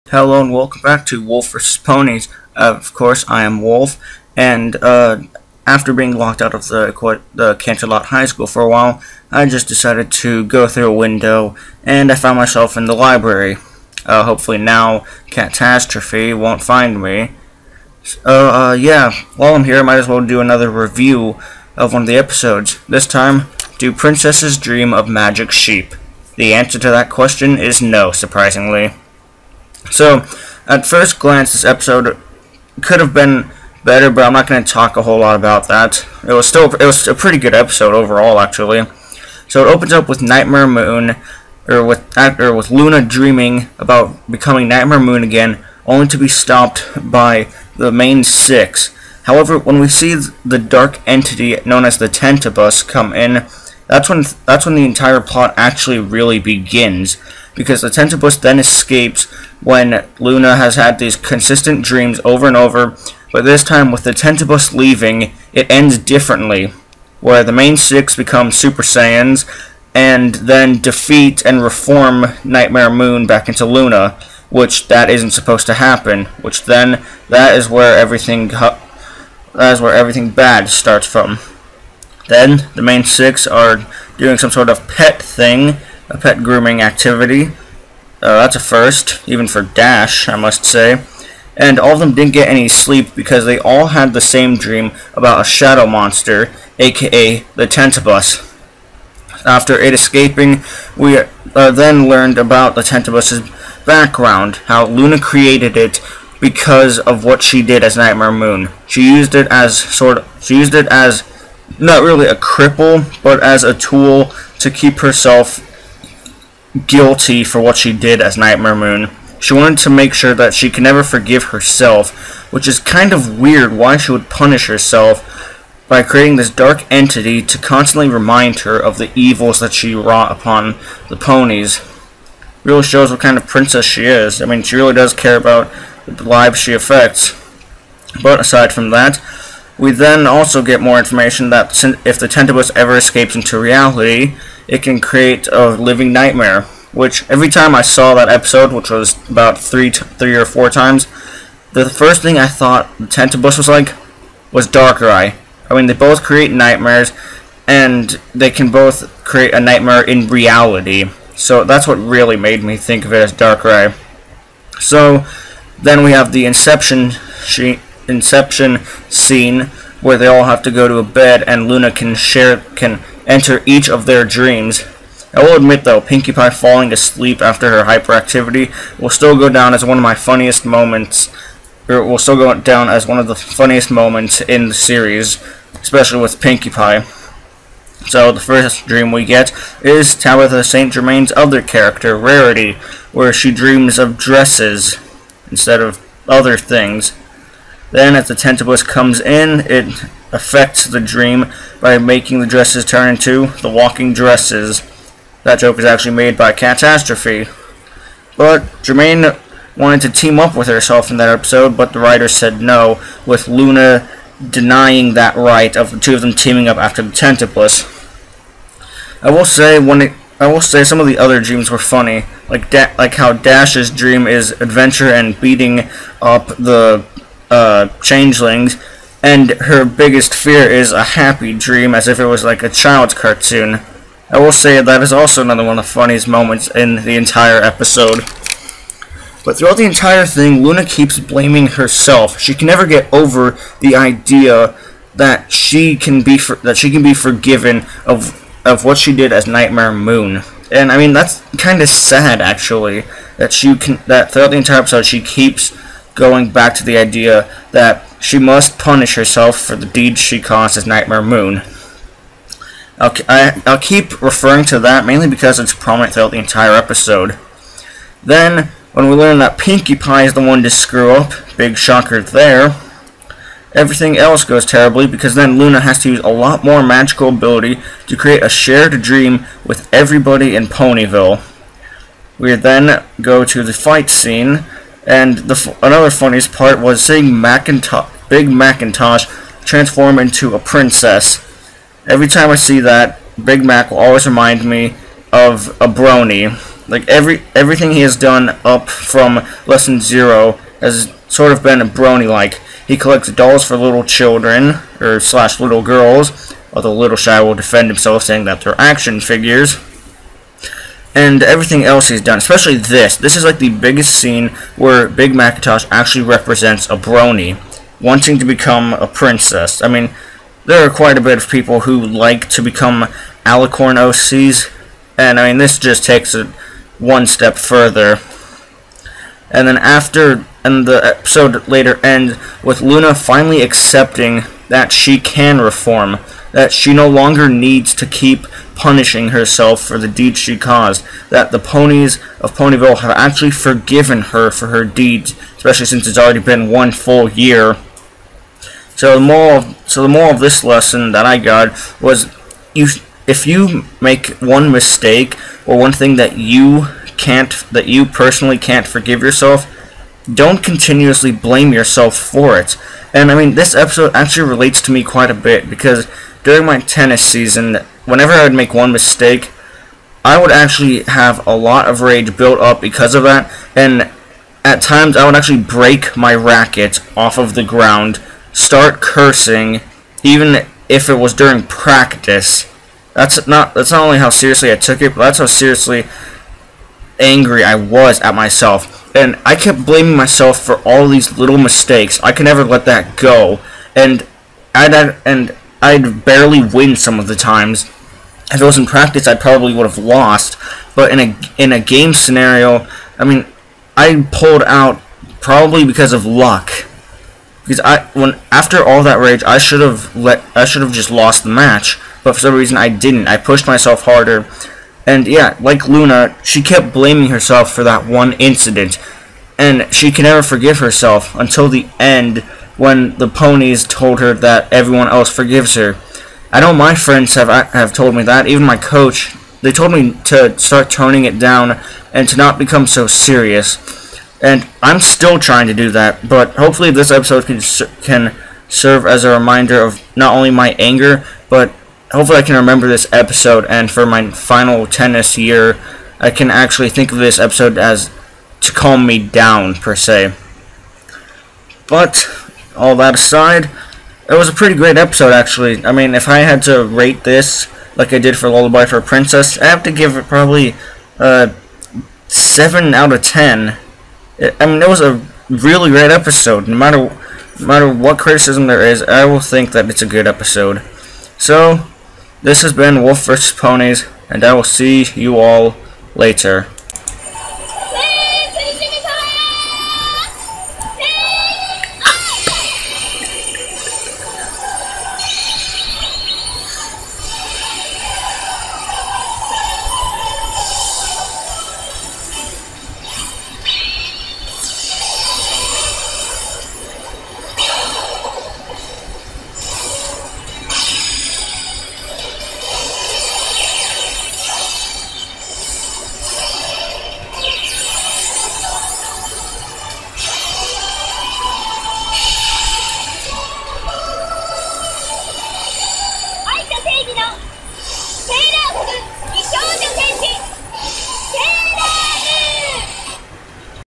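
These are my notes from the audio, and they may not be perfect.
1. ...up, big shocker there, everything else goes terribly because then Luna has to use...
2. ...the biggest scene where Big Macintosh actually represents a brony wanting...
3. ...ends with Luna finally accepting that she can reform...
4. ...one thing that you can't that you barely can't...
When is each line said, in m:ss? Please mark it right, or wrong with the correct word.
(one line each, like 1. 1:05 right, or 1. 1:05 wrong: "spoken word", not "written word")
1. 4:31 right
2. 5:13 right
3. 5:32 right
4. 5:55 wrong: "personally", not "barely".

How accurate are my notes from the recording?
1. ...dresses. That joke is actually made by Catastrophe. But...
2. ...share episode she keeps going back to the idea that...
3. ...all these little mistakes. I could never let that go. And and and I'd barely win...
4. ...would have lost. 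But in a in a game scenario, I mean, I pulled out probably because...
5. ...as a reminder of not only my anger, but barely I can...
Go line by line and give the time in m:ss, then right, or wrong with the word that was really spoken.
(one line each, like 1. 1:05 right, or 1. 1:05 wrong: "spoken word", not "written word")
1. 3:24 right
2. 4:14 wrong: "entire", not "share"
3. 6:30 right
4. 6:39 right
5. 7:19 wrong: "hopefully", not "barely".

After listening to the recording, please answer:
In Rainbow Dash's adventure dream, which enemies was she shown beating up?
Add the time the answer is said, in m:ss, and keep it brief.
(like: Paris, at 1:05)
changelings, at 3:48.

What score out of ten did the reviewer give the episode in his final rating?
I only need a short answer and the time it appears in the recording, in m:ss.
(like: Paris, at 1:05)
7 out of 10, at 7:42.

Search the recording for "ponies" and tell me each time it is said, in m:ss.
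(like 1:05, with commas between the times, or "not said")
0:01, 2:11, 5:41, 7:03, 7:53.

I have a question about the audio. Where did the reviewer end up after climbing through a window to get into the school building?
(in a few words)
the library.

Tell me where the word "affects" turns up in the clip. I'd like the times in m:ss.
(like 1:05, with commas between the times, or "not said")
2:16, 3:20.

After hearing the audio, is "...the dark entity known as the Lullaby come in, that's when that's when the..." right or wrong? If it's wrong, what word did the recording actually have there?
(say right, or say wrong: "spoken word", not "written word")
wrong: "Tentabus", not "Lullaby".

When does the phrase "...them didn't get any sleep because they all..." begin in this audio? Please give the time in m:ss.
1:31.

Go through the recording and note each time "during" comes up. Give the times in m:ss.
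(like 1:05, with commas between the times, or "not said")
6:06, 6:21.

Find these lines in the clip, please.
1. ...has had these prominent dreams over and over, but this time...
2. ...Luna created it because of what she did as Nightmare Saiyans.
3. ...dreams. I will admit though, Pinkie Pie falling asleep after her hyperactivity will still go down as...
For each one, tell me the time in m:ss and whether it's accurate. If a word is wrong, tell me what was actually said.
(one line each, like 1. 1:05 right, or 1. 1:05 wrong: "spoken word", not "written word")
1. 1:00 wrong: "consistent", not "prominent"
2. 1:44 wrong: "Moon", not "Saiyans"
3. 2:54 right.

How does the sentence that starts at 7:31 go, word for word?
But all that aside, it was a pretty great episode, actually.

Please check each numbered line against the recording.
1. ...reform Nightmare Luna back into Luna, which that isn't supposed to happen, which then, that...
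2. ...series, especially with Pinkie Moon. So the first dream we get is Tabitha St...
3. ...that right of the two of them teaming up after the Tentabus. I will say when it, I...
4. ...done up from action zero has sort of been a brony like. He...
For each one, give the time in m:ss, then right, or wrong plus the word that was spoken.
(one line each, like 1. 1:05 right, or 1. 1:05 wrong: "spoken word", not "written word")
1. 1:11 wrong: "Moon", not "Luna"
2. 3:04 wrong: "Pie", not "Moon"
3. 3:35 right
4. 4:58 wrong: "lesson", not "action".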